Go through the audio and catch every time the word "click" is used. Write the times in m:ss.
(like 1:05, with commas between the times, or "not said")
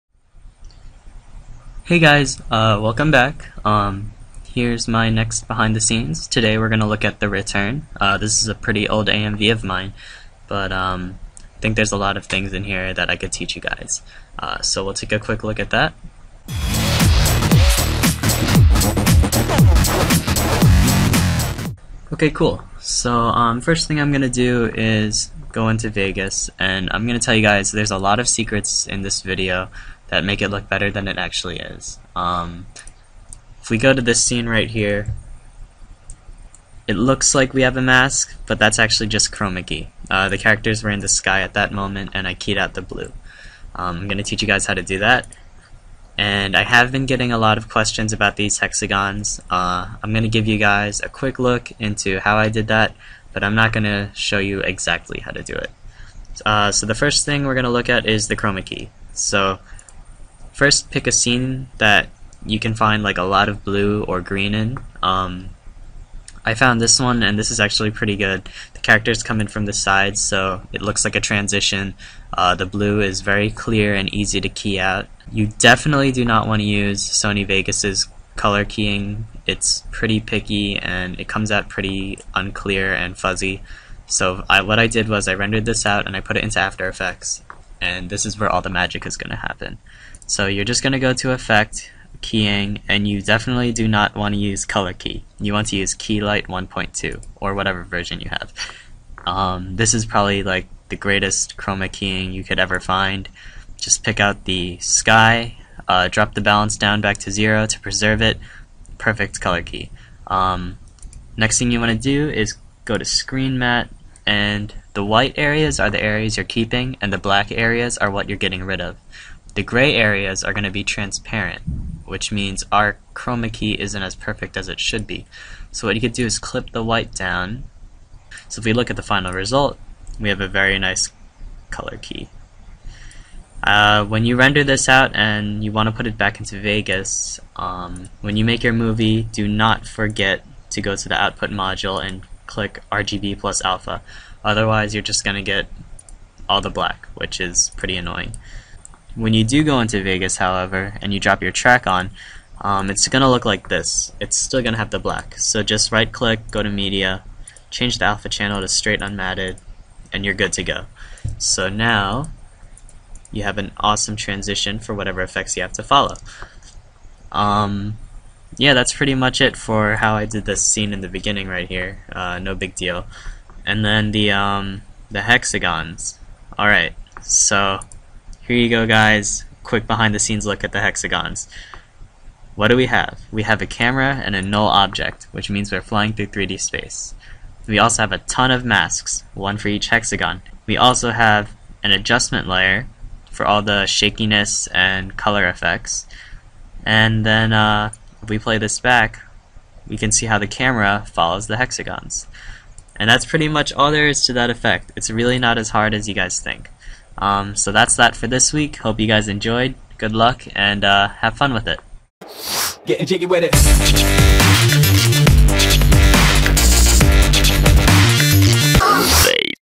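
2:22, 2:36.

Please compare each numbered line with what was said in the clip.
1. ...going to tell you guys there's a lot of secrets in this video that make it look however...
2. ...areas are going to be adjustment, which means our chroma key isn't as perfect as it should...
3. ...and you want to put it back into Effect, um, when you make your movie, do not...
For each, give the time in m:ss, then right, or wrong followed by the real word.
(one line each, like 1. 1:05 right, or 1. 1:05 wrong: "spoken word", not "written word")
1. 0:27 wrong: "better", not "however"
2. 1:59 wrong: "transparent", not "adjustment"
3. 2:15 wrong: "Vegas", not "Effect".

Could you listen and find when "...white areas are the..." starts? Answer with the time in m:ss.
1:55.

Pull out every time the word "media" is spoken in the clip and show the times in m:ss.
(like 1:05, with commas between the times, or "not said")
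2:36.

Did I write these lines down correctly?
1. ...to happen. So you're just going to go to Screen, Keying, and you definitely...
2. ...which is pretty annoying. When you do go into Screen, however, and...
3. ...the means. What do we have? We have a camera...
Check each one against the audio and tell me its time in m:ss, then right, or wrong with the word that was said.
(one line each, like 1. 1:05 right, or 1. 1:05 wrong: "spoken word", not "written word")
1. 1:29 wrong: "Effect", not "Screen"
2. 2:27 wrong: "Vegas", not "Screen"
3. 3:00 wrong: "hexagons", not "means".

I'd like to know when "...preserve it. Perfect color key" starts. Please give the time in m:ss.
1:47.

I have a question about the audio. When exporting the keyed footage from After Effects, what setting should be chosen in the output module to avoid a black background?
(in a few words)
RGB plus alpha.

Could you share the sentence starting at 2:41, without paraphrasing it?
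So now you have an awesome transition for whatever effects you have to follow.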